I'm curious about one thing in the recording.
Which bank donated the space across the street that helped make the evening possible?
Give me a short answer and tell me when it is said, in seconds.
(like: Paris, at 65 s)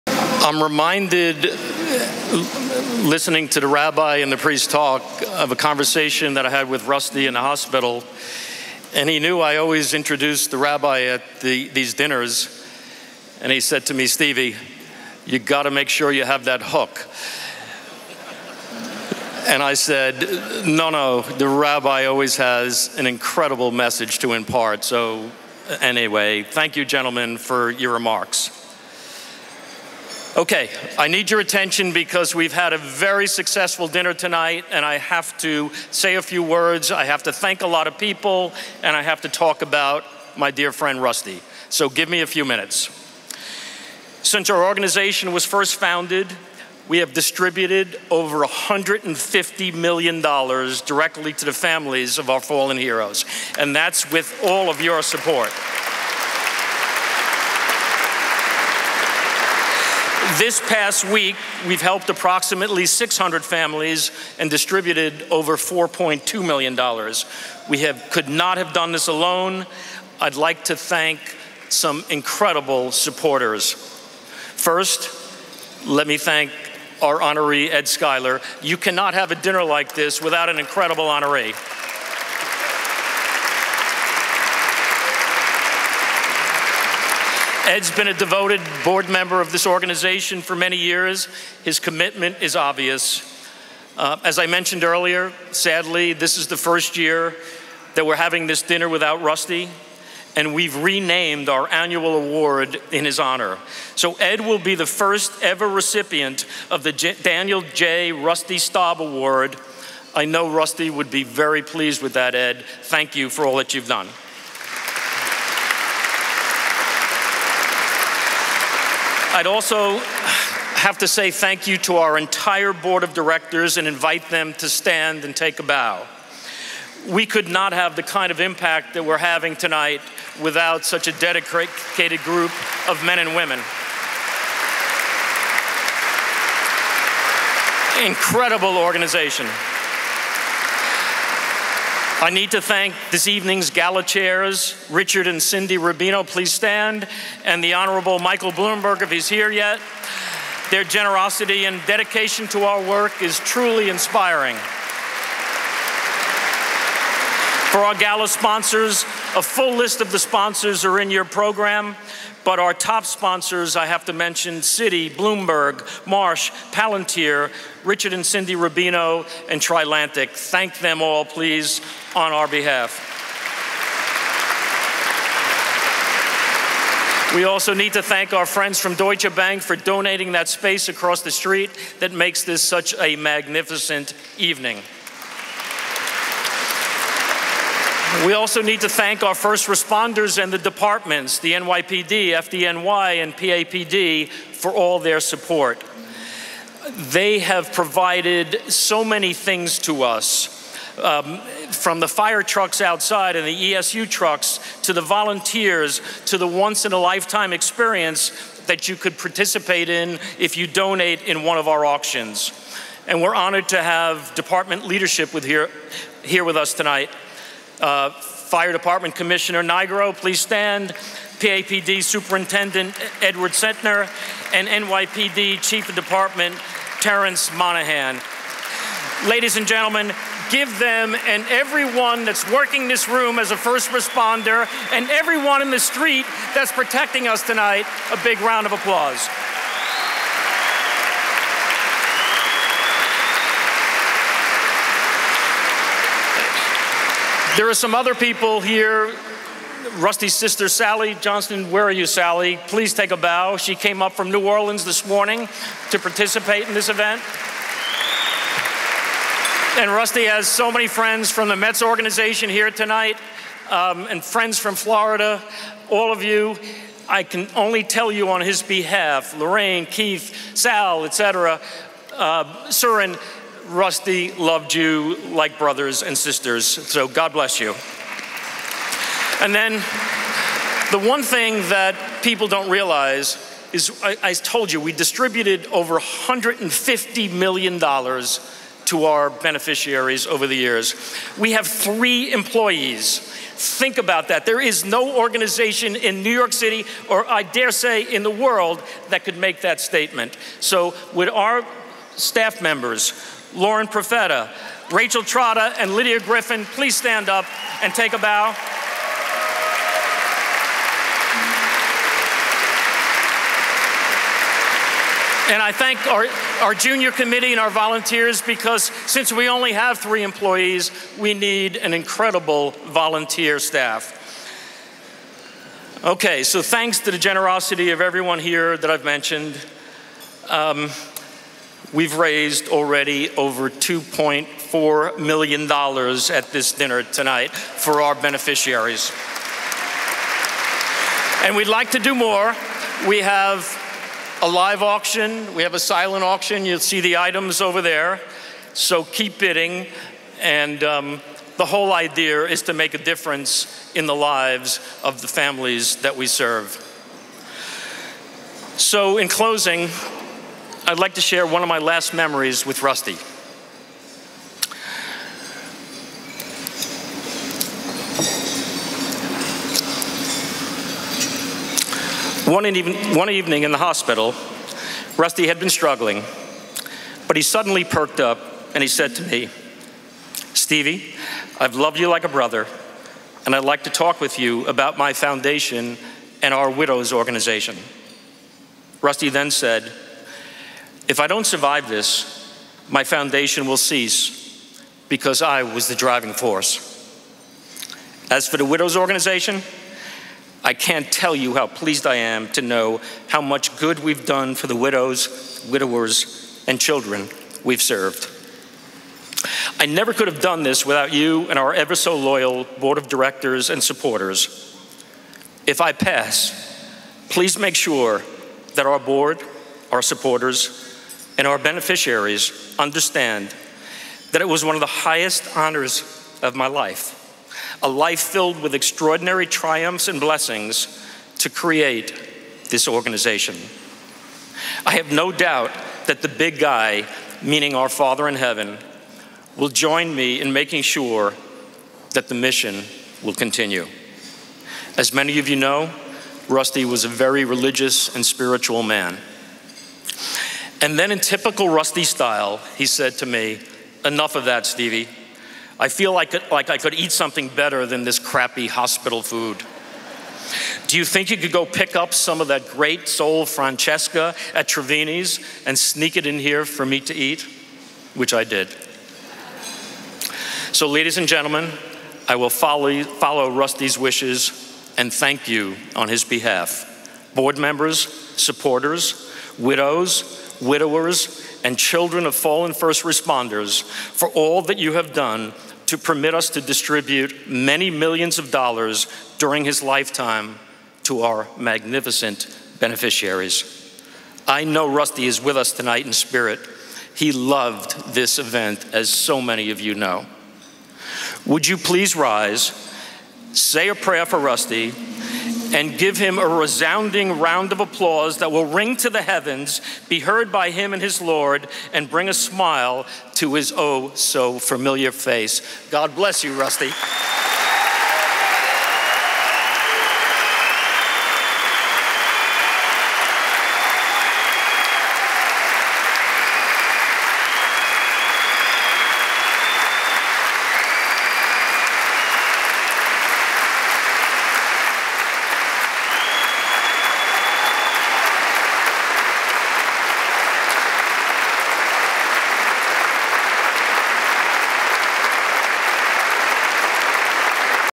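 Deutsche Bank, at 178 s.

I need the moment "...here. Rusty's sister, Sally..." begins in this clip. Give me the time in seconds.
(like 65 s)
248 s.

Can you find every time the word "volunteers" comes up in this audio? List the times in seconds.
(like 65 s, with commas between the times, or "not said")
205 s, 317 s, 322 s.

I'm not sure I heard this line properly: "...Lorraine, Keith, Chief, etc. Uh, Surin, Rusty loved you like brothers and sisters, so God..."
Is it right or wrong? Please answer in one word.
wrong.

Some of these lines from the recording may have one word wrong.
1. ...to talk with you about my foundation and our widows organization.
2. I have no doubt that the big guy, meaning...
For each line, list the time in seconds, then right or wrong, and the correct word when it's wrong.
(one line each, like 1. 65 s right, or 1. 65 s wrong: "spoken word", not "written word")
1. 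383 s right
2. 434 s right.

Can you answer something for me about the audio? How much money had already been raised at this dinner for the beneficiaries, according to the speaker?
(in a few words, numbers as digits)
$2.4 million.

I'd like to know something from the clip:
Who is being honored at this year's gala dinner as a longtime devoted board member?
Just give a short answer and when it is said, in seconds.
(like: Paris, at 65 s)
Ed Schuyler, at 77 s.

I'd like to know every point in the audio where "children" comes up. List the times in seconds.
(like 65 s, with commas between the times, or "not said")
406 s, 481 s.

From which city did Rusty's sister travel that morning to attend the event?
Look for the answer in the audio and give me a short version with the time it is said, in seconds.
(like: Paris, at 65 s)
New Orleans, at 254 s.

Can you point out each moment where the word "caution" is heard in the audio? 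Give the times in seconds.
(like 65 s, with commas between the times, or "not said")
not said.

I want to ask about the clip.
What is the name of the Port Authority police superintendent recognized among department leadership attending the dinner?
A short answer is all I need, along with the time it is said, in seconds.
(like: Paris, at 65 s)
Edward Cetnar, at 223 s.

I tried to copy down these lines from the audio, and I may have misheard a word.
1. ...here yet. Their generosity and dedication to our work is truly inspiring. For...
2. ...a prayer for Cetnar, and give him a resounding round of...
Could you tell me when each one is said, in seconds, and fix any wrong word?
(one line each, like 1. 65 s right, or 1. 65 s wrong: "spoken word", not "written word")
1. 149 s right
2. 503 s wrong: "Rusty", not "Cetnar".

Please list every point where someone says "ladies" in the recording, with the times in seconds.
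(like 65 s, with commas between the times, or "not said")
229 s, 470 s.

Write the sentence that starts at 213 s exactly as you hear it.
And we're honored to have department leadership with here, here with us tonight.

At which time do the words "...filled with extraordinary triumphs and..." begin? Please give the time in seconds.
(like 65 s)
428 s.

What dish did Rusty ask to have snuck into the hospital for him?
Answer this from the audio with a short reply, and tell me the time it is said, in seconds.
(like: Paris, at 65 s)
sole Francesca, at 463 s.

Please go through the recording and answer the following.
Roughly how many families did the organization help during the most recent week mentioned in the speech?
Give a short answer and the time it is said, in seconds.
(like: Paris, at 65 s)
600, at 62 s.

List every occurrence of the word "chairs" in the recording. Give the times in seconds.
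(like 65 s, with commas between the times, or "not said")
144 s.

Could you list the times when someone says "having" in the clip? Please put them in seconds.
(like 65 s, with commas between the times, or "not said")
98 s, 129 s.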